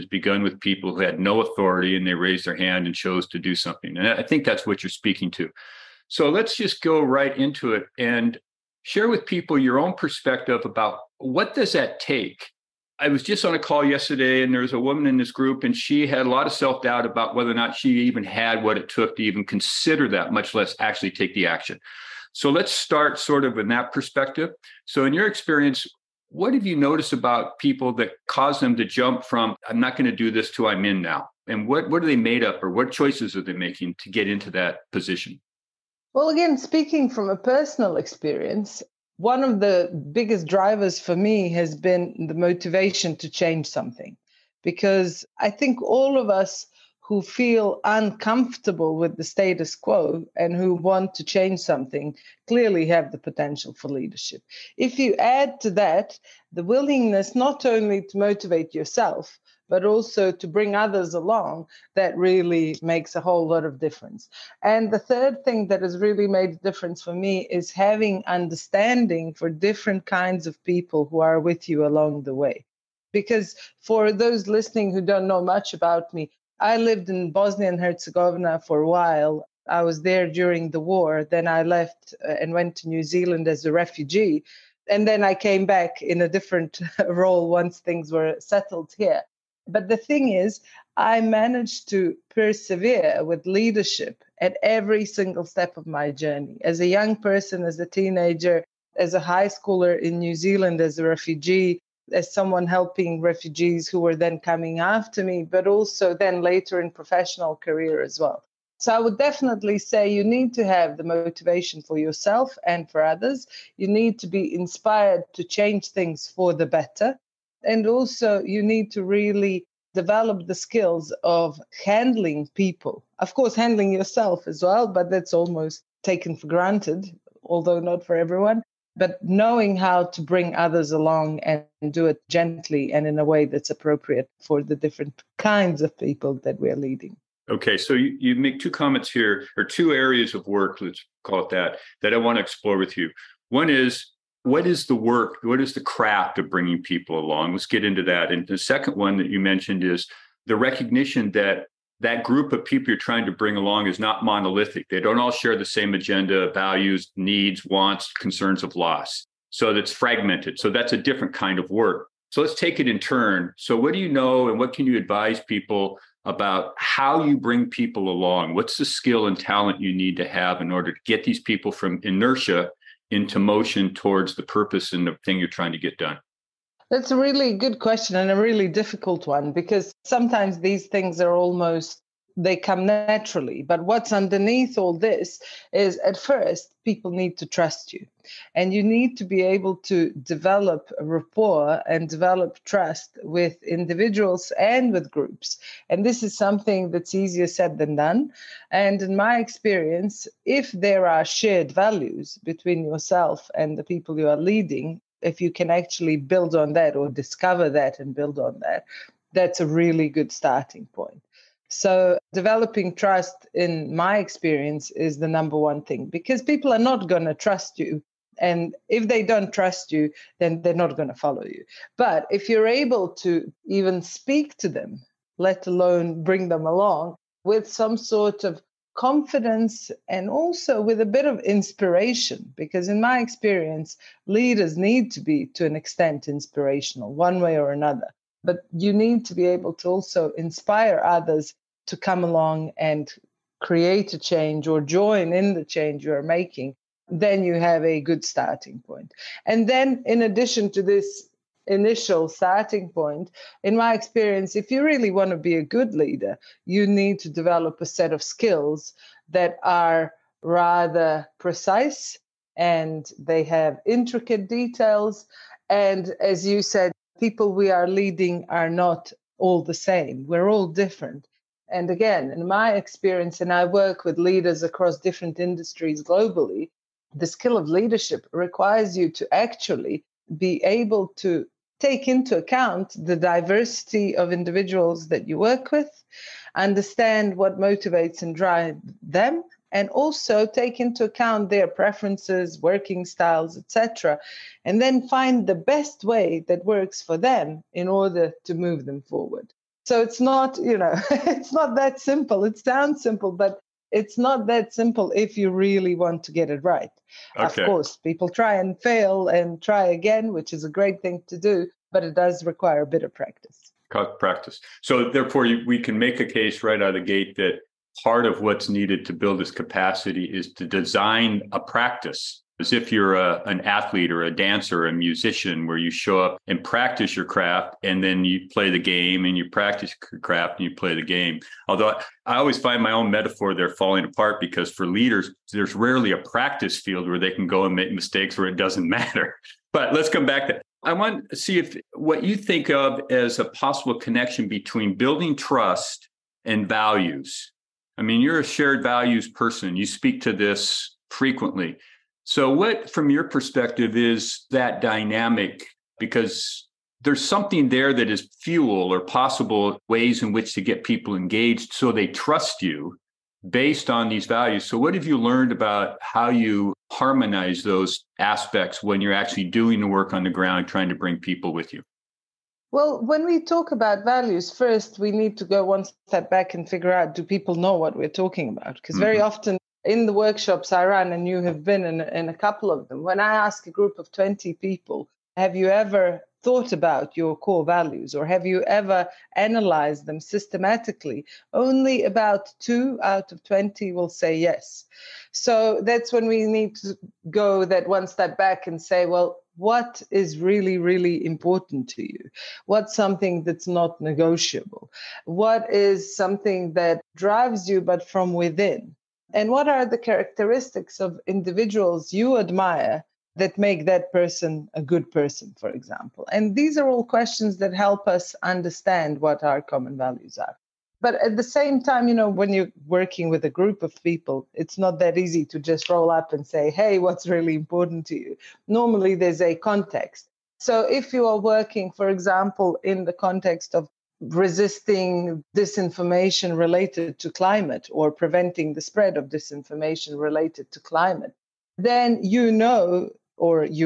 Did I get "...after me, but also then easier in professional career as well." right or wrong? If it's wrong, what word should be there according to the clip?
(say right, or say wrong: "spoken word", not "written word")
wrong: "later", not "easier".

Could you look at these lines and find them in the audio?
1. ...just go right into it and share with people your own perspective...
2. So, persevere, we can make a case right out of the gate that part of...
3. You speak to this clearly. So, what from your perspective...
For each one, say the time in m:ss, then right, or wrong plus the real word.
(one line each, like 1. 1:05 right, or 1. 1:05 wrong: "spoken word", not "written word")
1. 0:06 right
2. 5:14 wrong: "therefore", not "persevere"
3. 5:49 wrong: "frequently", not "clearly".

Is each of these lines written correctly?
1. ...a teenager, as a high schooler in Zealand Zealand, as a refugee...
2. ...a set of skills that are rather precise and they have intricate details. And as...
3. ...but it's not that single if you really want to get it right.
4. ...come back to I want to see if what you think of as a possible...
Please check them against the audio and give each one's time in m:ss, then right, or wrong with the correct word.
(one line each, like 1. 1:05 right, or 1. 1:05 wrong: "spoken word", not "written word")
1. 1:37 wrong: "New", not "Zealand"
2. 4:17 right
3. 5:03 wrong: "simple", not "single"
4. 5:40 right.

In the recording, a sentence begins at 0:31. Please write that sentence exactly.
And what, what are they made up or what choices are they making to get into that position?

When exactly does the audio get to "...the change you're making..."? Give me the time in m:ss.
4:05.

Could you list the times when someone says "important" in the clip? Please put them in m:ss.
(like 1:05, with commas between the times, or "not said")
6:41, 7:07.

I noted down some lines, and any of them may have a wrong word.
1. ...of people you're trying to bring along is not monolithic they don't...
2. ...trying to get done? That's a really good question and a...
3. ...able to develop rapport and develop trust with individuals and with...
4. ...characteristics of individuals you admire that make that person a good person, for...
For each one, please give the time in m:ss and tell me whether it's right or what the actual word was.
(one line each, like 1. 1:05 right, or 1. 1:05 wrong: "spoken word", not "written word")
1. 2:32 right
2. 2:55 right
3. 3:09 right
4. 6:49 right.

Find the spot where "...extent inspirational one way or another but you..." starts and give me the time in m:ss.
3:55.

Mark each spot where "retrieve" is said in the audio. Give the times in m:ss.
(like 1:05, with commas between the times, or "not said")
not said.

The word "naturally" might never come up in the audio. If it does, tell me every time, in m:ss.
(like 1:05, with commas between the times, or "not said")
3:02.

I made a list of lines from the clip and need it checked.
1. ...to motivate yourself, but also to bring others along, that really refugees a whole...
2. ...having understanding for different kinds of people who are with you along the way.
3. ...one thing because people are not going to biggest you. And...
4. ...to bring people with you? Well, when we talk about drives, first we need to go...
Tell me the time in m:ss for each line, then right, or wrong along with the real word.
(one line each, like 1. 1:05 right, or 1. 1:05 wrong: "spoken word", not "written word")
1. 0:58 wrong: "makes", not "refugees"
2. 1:07 right
3. 3:35 wrong: "trust", not "biggest"
4. 6:10 wrong: "values", not "drives".